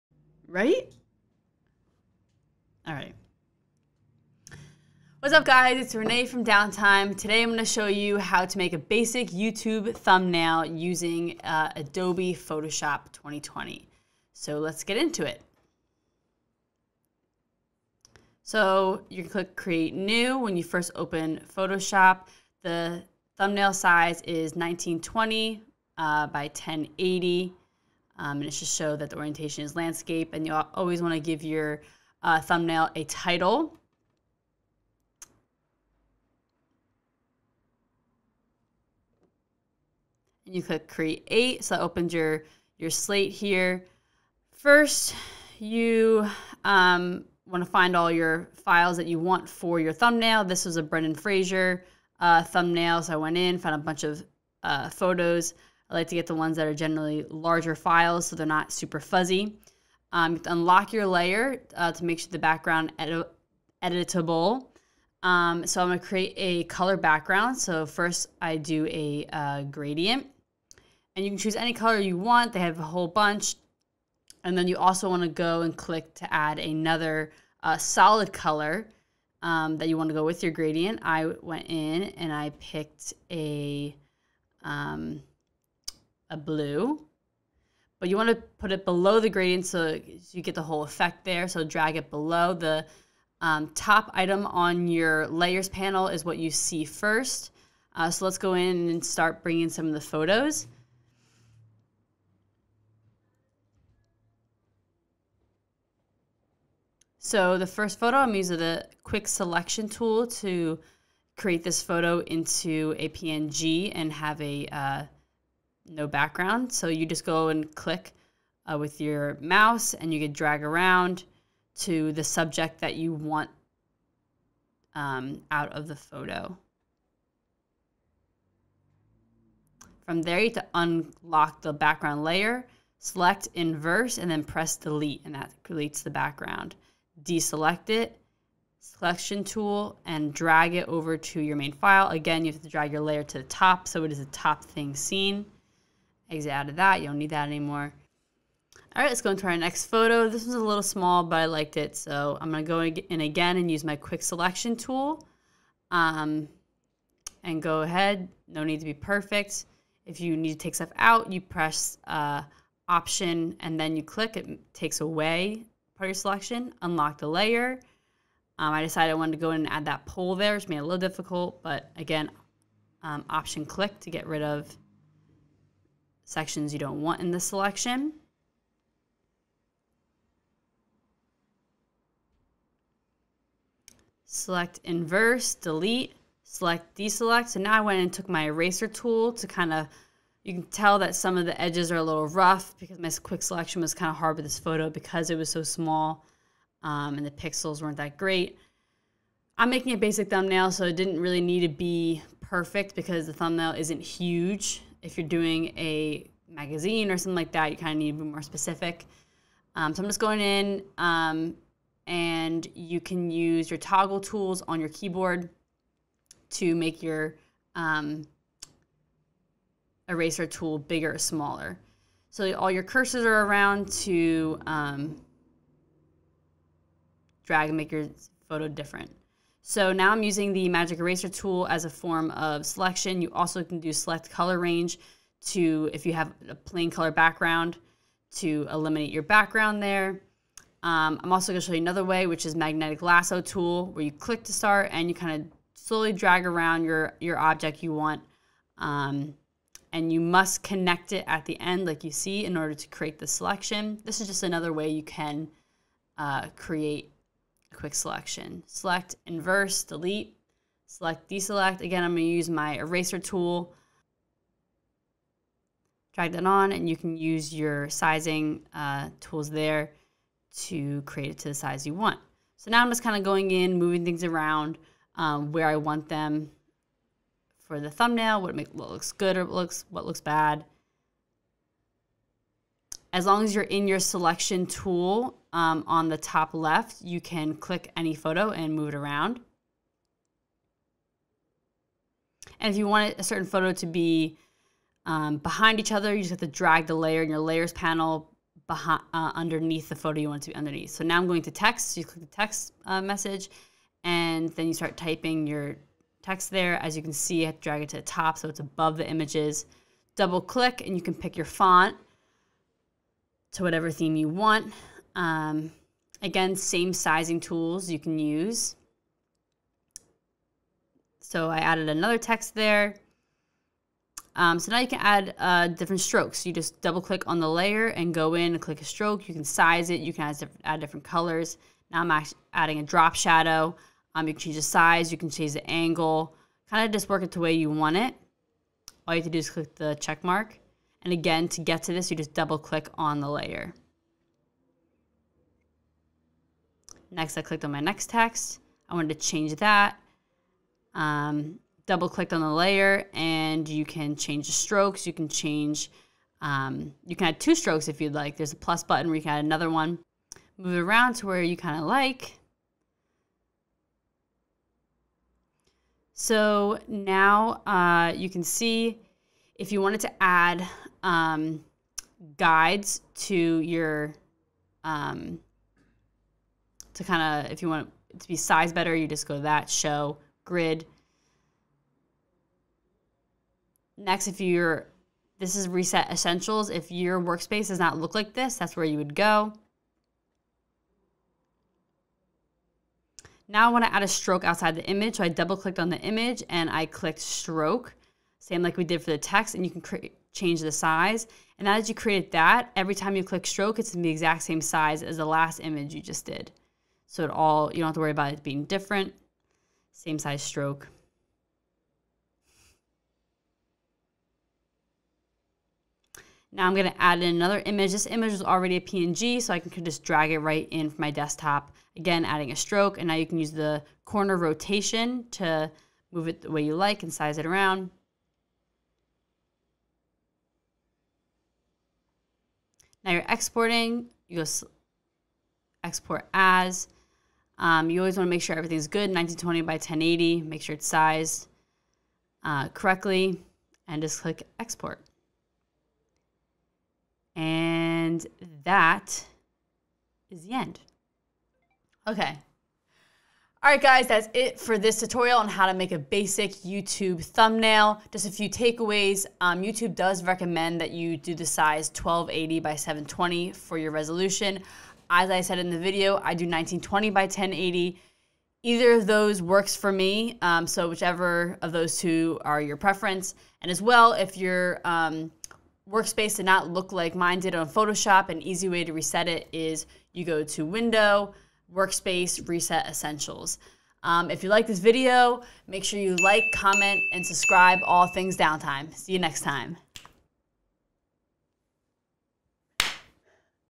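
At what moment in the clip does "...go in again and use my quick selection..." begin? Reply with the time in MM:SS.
02:32.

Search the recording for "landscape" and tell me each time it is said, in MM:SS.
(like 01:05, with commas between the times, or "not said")
00:29.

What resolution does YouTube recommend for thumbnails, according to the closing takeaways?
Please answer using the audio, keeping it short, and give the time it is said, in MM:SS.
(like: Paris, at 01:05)
1280 by 720, at 07:41.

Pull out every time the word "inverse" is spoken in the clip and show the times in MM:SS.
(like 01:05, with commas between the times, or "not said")
02:13, 03:04, 04:19.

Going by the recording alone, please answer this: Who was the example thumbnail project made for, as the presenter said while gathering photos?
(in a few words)
Brendan Fraser.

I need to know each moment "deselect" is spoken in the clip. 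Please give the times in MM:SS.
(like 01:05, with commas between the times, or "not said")
02:17, 03:06, 04:21.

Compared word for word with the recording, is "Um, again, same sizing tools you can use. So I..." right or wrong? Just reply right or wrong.
right.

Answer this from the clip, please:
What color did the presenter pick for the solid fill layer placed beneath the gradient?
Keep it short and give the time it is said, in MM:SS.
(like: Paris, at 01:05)
Blue, at 01:26.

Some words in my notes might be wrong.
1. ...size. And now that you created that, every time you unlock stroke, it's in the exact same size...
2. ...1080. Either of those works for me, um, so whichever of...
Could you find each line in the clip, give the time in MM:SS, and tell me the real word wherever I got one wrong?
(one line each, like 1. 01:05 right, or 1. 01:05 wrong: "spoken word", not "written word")
1. 06:40 wrong: "click", not "unlock"
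2. 07:47 right.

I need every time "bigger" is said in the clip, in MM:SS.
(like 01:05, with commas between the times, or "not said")
03:40.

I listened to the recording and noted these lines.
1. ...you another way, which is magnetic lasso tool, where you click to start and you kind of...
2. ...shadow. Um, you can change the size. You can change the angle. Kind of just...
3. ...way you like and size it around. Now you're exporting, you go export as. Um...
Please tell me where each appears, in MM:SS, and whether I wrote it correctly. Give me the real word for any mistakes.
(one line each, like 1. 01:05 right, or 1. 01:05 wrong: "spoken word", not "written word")
1. 04:01 right
2. 05:33 right
3. 07:06 right.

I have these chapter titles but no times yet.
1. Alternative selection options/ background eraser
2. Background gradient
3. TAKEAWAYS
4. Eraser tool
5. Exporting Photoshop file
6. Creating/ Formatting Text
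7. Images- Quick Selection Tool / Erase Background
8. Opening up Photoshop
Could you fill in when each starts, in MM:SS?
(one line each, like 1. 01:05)
1. 03:45
2. 00:58
3. 07:31
4. 03:06
5. 07:10
6. 05:02
7. 01:49
8. 00:15.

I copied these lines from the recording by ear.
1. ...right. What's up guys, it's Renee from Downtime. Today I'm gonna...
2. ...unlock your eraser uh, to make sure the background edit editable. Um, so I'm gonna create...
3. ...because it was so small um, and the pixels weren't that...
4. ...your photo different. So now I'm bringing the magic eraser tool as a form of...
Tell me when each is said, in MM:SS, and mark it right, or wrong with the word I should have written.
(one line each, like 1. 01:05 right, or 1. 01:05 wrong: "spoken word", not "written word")
1. 00:02 right
2. 01:00 wrong: "layer", not "eraser"
3. 03:14 right
4. 03:47 wrong: "using", not "bringing".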